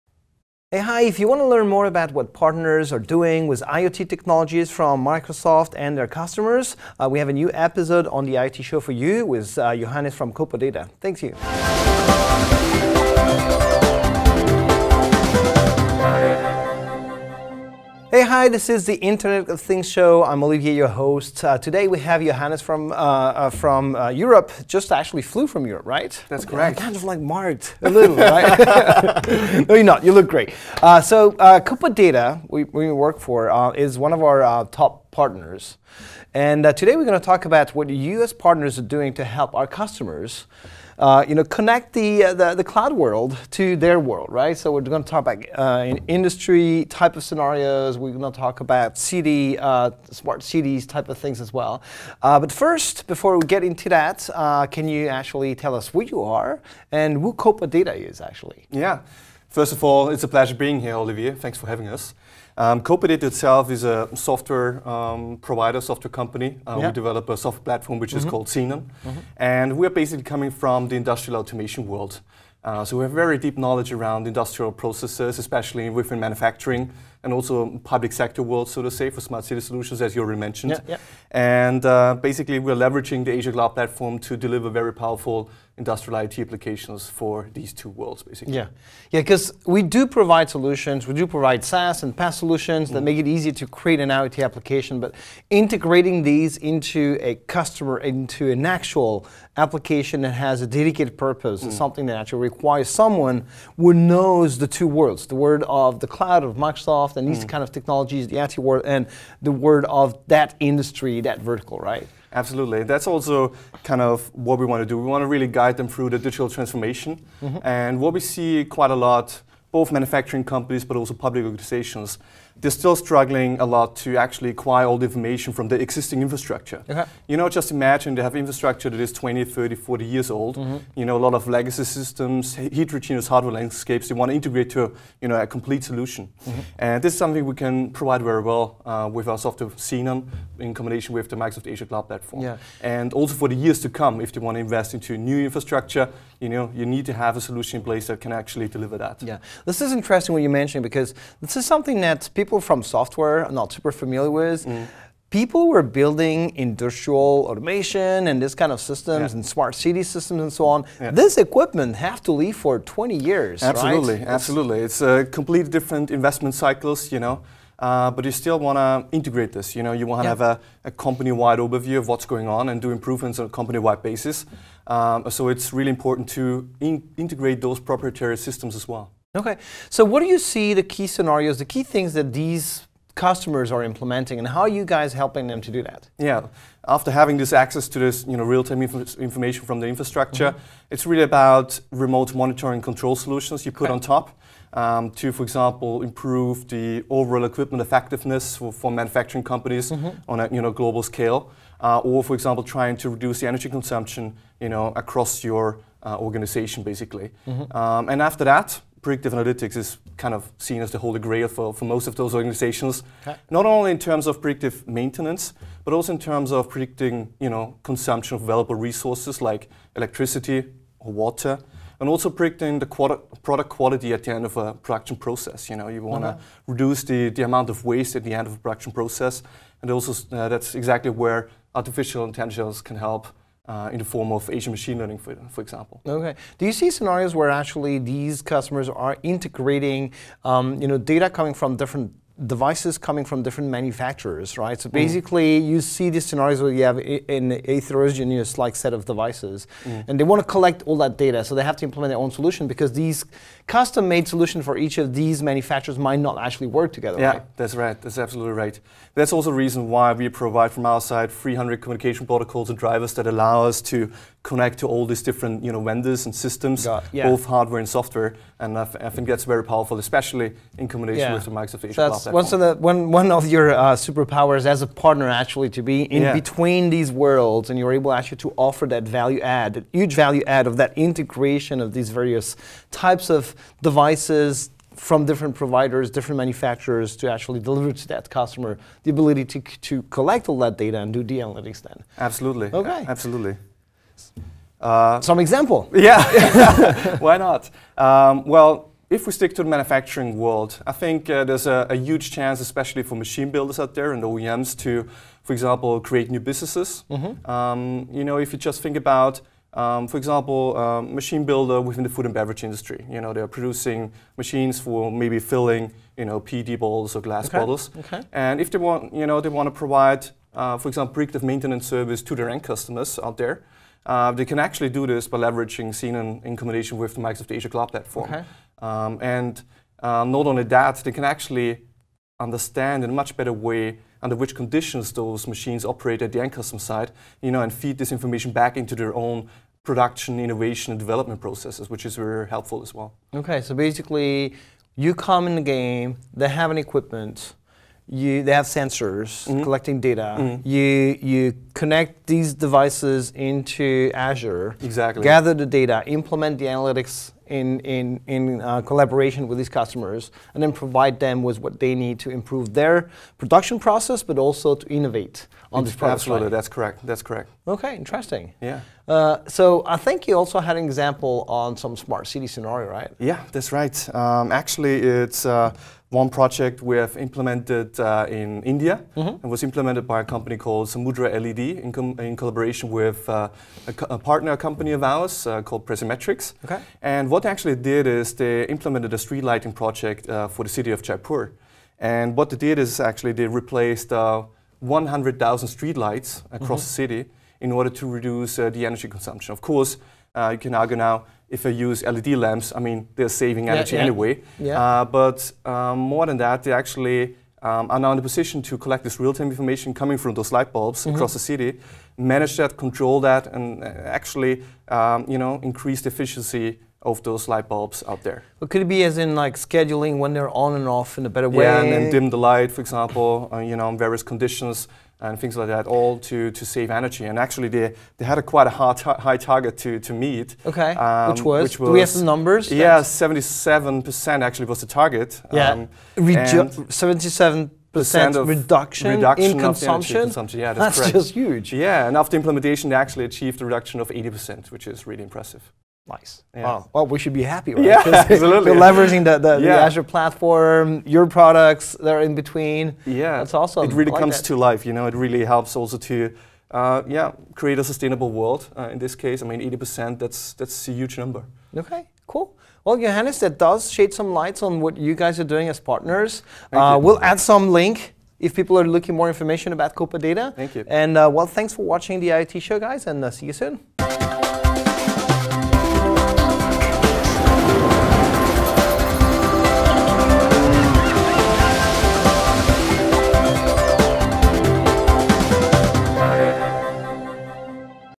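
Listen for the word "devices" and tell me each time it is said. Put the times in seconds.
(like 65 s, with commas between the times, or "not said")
242 s, 249 s, 283 s, 352 s.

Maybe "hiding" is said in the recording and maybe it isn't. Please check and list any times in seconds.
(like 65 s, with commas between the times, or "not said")
not said.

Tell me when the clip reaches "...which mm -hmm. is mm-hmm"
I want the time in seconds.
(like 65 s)
67 s.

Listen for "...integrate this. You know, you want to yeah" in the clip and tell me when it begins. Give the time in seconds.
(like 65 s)
169 s.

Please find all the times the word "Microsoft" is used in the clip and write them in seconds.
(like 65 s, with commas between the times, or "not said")
5 s, 106 s, 141 s, 271 s, 327 s.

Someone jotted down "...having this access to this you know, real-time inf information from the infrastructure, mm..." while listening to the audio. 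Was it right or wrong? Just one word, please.
right.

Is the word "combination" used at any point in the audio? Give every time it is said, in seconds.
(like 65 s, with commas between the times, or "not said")
140 s, 270 s, 326 s.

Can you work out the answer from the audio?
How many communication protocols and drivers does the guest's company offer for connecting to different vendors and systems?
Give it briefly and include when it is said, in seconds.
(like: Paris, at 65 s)
300, at 261 s.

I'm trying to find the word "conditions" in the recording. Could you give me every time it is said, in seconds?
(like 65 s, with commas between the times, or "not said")
334 s, 424 s.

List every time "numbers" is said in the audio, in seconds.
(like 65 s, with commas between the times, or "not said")
432 s, 461 s.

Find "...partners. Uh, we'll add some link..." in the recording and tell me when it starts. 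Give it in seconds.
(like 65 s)
465 s.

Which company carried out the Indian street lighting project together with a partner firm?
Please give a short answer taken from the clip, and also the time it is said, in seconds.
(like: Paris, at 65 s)
Samudra LED, at 380 s.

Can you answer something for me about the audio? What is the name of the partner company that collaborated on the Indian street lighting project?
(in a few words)
Presimetrics.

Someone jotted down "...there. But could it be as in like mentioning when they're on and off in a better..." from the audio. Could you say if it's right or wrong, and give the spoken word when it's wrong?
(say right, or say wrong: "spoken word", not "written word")
wrong: "scheduling", not "mentioning".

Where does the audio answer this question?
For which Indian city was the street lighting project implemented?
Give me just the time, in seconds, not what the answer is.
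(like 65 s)
391 s.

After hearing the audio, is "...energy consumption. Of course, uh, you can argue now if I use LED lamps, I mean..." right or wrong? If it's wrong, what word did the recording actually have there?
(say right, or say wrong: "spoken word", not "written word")
right.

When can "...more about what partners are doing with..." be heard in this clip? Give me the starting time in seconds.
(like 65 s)
1 s.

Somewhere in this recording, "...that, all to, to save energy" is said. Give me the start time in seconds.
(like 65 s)
425 s.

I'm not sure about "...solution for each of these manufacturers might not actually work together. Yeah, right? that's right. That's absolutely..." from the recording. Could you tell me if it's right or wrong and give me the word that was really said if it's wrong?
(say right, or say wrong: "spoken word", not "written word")
right.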